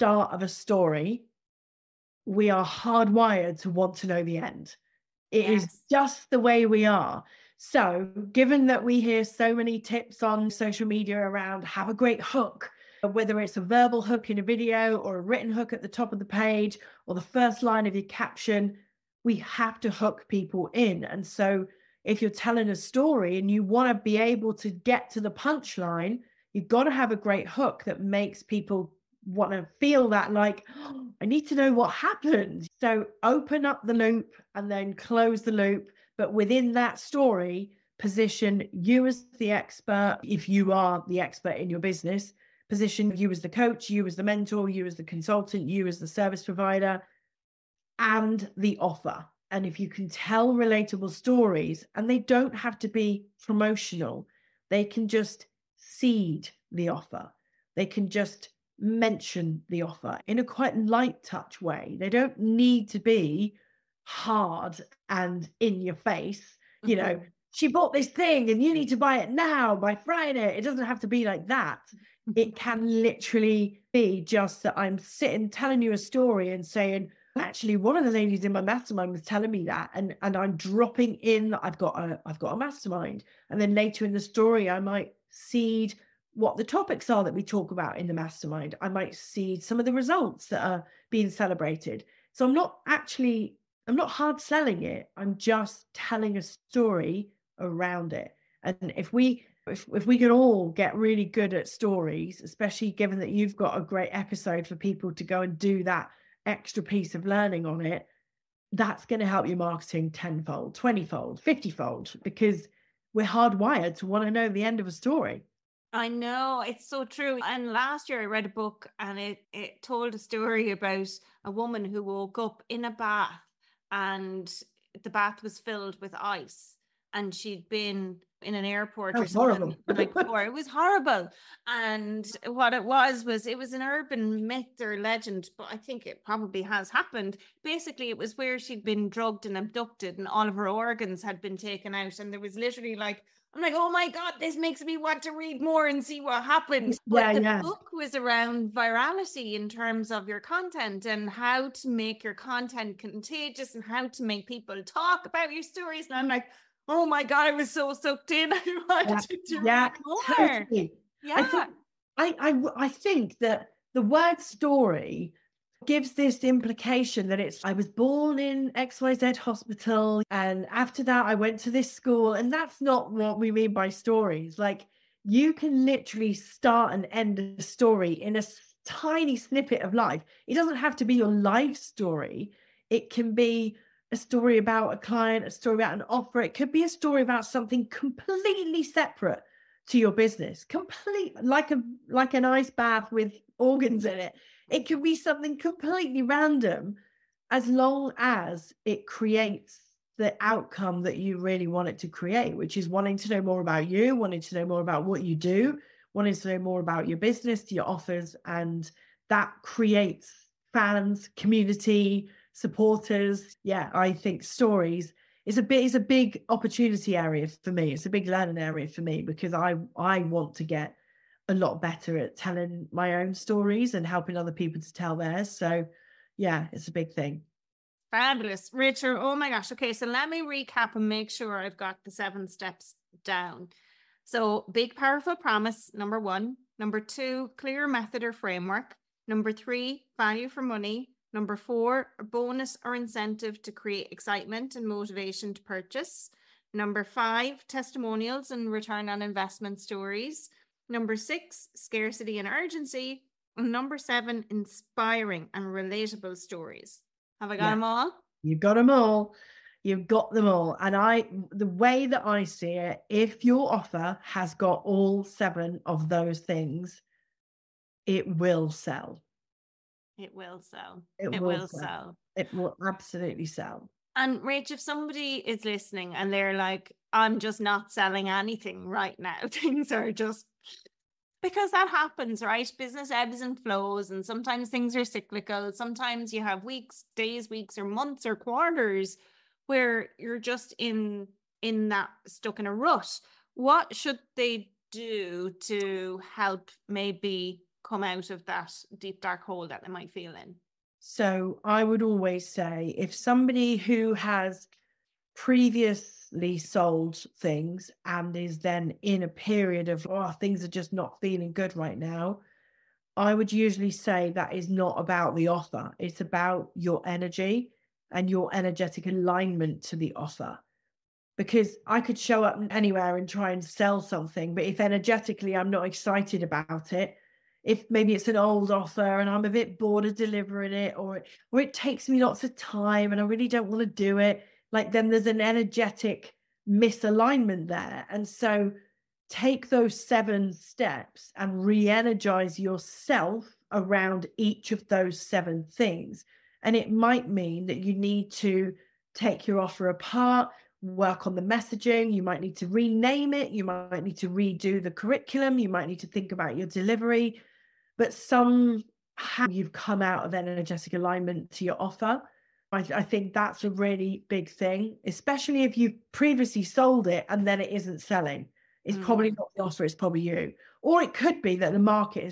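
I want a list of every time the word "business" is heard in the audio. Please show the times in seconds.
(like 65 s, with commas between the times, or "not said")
41 s, 190 s, 207 s, 282 s.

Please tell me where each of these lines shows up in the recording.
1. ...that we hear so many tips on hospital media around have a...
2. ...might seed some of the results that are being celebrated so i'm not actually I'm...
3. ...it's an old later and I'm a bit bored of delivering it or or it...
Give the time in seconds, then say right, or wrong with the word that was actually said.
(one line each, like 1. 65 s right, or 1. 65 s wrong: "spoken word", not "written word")
1. 8 s wrong: "social", not "hospital"
2. 88 s right
3. 328 s wrong: "offer", not "later".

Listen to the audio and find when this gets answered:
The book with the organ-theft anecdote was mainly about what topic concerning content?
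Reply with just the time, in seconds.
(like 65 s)
148 s.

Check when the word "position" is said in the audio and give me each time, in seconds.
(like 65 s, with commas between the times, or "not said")
37 s, 42 s.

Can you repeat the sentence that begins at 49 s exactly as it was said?
And if you can tell relatable stories, and they don't have to be promotional, they can just seed the offer.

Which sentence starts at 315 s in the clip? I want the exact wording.
It's about your energy and your energetic alignment to the offer.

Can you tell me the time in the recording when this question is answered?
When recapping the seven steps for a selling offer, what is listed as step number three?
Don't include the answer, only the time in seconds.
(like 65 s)
240 s.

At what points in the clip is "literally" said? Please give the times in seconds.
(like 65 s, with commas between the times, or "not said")
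73 s, 142 s, 175 s.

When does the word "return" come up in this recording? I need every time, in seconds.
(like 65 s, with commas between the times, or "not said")
248 s.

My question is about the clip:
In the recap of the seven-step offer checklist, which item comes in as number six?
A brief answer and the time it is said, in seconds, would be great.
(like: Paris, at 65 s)
scarcity and urgency, at 251 s.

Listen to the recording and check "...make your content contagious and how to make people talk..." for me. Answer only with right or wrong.
right.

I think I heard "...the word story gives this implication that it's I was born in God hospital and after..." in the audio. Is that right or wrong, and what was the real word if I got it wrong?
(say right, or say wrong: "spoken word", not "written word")
wrong: "XYZ", not "God".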